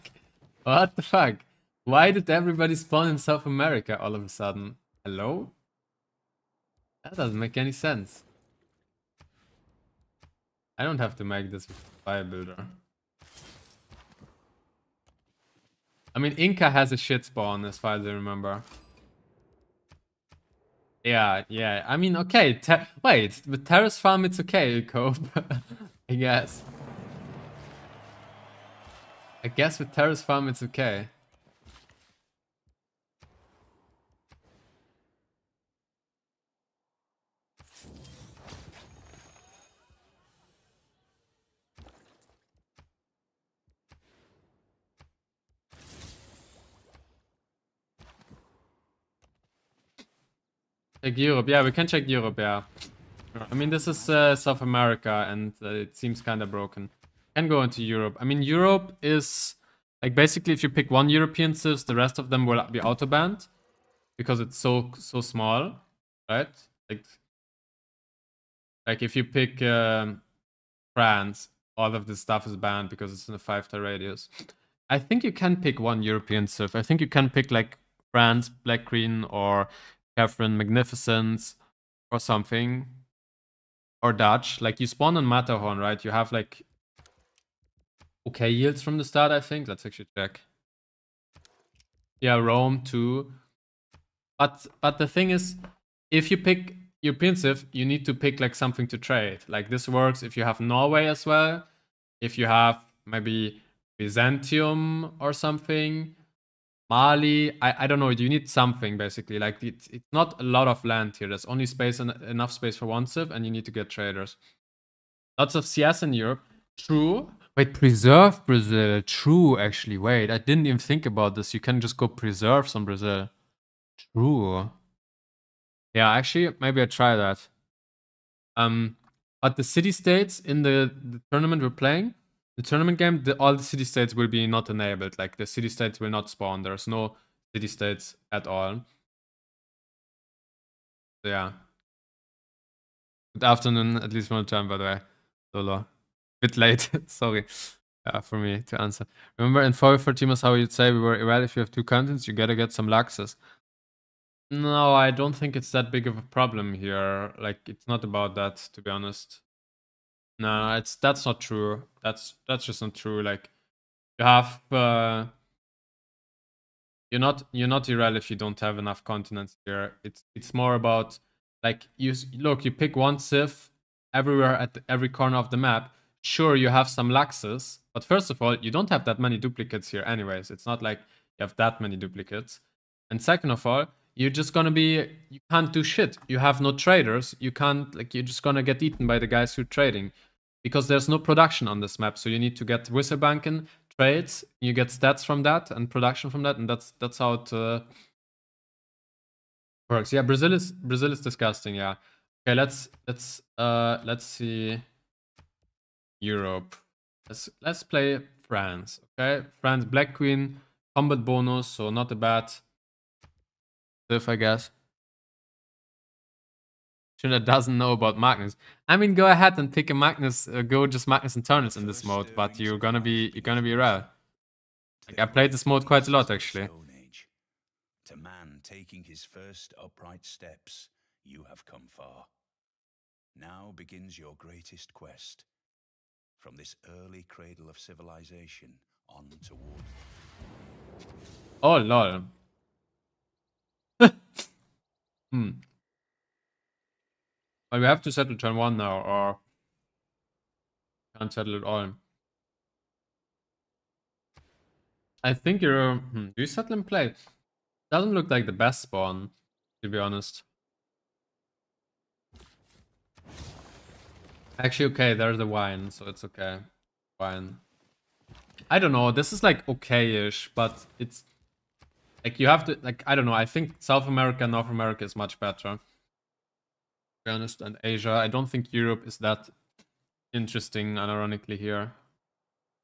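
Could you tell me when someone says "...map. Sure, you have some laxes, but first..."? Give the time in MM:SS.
02:55.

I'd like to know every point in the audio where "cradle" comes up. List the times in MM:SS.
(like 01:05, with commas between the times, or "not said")
03:57.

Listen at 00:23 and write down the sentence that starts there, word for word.
wait, the terrace farm, it's okay, cope.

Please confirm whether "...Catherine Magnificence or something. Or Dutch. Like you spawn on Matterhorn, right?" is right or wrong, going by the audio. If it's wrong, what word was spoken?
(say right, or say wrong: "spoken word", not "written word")
right.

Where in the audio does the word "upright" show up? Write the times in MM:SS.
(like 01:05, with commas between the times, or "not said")
03:49.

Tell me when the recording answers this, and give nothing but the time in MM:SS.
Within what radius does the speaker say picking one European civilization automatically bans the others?
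01:13.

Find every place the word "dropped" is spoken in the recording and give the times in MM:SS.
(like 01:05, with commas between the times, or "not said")
not said.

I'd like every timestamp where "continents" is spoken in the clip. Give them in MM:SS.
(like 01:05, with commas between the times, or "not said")
02:31, 02:49.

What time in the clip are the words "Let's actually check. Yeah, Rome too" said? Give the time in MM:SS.
01:29.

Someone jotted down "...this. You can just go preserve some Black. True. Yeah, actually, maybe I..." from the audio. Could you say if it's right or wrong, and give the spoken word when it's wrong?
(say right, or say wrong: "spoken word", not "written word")
wrong: "Brazil", not "Black".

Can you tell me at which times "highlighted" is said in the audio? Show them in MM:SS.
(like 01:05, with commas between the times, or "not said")
not said.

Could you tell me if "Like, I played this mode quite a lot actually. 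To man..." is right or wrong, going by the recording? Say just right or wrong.
right.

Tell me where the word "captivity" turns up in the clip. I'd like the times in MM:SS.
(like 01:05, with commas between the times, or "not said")
not said.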